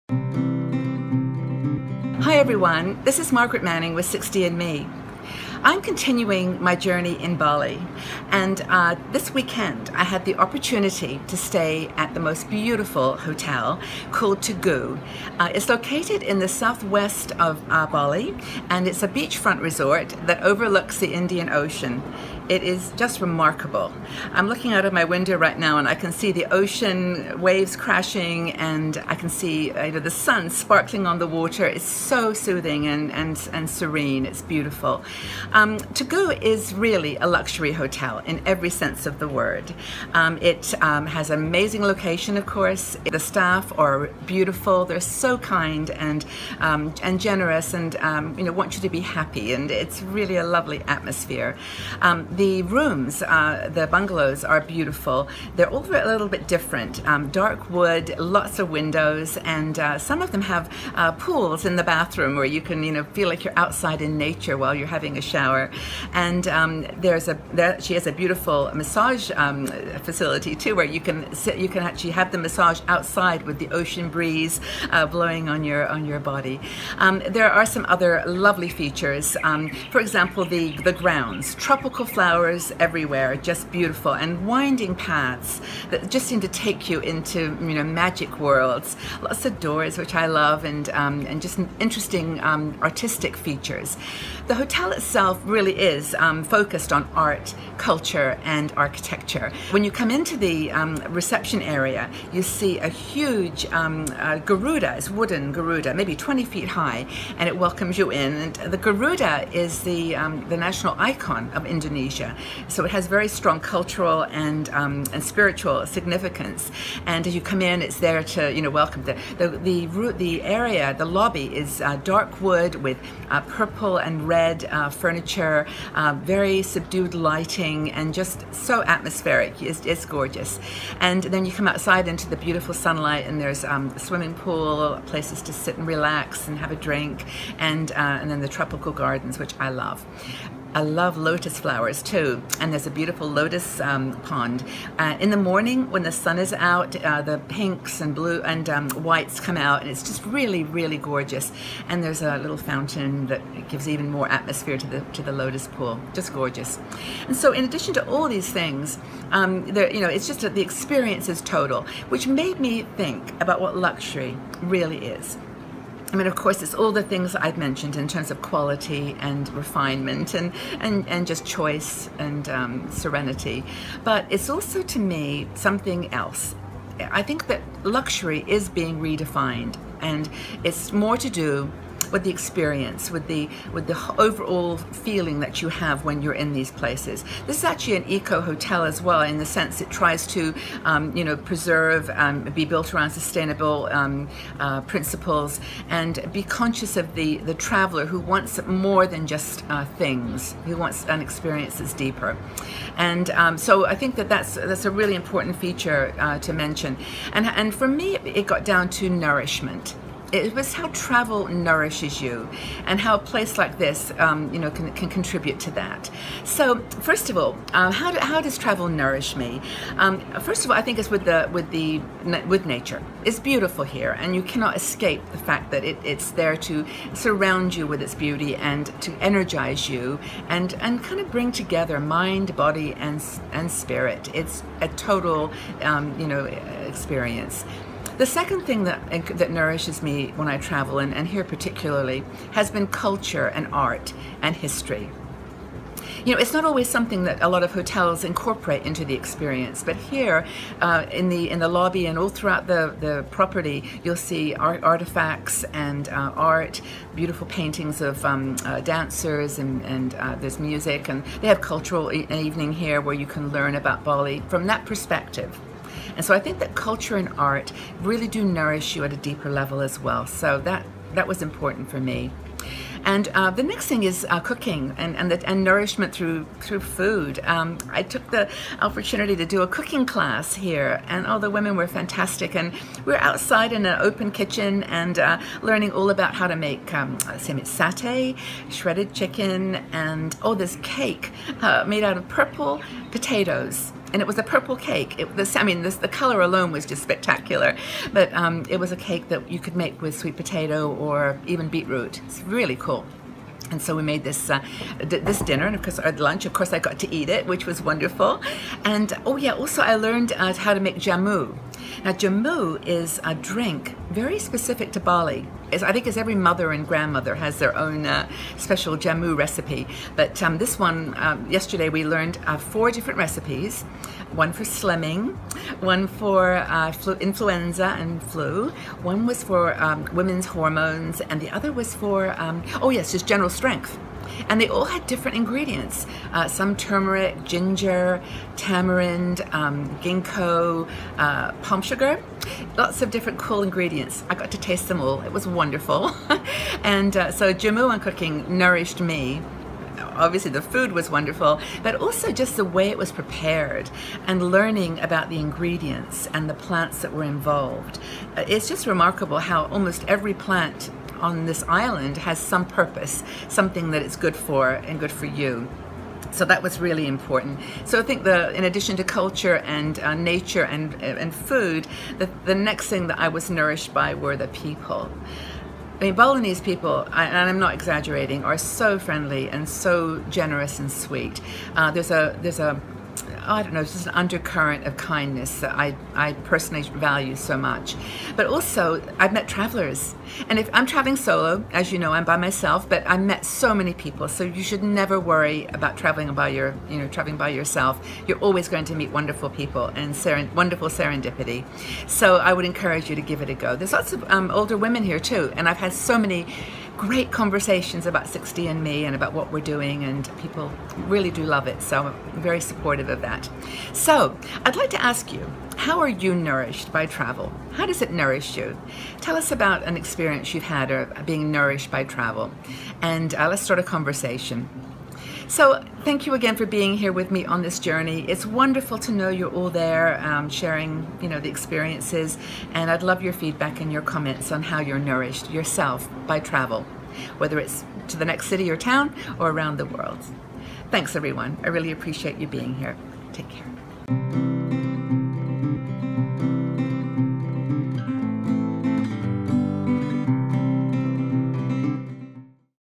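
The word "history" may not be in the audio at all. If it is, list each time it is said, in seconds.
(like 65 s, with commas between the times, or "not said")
244 s.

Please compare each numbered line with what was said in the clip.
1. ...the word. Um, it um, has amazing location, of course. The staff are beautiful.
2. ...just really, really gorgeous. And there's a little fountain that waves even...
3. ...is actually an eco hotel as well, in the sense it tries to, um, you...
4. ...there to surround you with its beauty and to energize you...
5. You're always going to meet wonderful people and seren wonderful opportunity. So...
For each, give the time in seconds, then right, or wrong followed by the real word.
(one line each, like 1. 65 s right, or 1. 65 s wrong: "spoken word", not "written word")
1. 39 s right
2. 150 s wrong: "gives", not "waves"
3. 187 s right
4. 226 s right
5. 398 s wrong: "serendipity", not "opportunity".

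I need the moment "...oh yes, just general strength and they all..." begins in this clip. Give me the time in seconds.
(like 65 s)
332 s.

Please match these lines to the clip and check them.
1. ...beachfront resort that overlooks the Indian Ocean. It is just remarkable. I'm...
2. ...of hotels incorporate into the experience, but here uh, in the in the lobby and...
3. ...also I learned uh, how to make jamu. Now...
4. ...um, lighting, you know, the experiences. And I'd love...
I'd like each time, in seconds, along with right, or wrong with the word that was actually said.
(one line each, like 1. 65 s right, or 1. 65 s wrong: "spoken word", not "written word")
1. 19 s right
2. 247 s right
3. 309 s right
4. 430 s wrong: "sharing", not "lighting".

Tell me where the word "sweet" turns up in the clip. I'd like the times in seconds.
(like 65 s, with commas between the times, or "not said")
300 s, 380 s.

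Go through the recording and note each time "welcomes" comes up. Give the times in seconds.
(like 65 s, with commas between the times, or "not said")
107 s, 118 s.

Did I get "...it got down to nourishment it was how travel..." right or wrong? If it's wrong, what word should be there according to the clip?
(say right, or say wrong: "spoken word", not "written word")
right.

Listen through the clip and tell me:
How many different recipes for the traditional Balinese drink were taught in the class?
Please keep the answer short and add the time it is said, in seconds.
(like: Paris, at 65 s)
4, at 322 s.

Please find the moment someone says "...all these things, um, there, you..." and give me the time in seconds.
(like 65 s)
158 s.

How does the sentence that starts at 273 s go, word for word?
And uh, the next thing is uh, cooking and and, the, and, nourishment through through food.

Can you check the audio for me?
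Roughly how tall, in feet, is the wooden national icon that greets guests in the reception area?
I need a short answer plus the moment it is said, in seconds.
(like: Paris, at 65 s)
20 feet, at 106 s.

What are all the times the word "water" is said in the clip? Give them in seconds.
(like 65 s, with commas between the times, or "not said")
31 s.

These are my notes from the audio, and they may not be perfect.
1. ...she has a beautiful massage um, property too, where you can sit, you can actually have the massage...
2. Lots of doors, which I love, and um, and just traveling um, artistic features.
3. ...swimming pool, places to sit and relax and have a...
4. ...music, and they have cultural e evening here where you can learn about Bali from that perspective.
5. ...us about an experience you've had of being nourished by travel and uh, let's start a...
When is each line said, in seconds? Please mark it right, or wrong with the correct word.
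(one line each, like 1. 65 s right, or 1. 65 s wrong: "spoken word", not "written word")
1. 67 s wrong: "facility", not "property"
2. 89 s wrong: "interesting", not "traveling"
3. 133 s right
4. 260 s right
5. 419 s right.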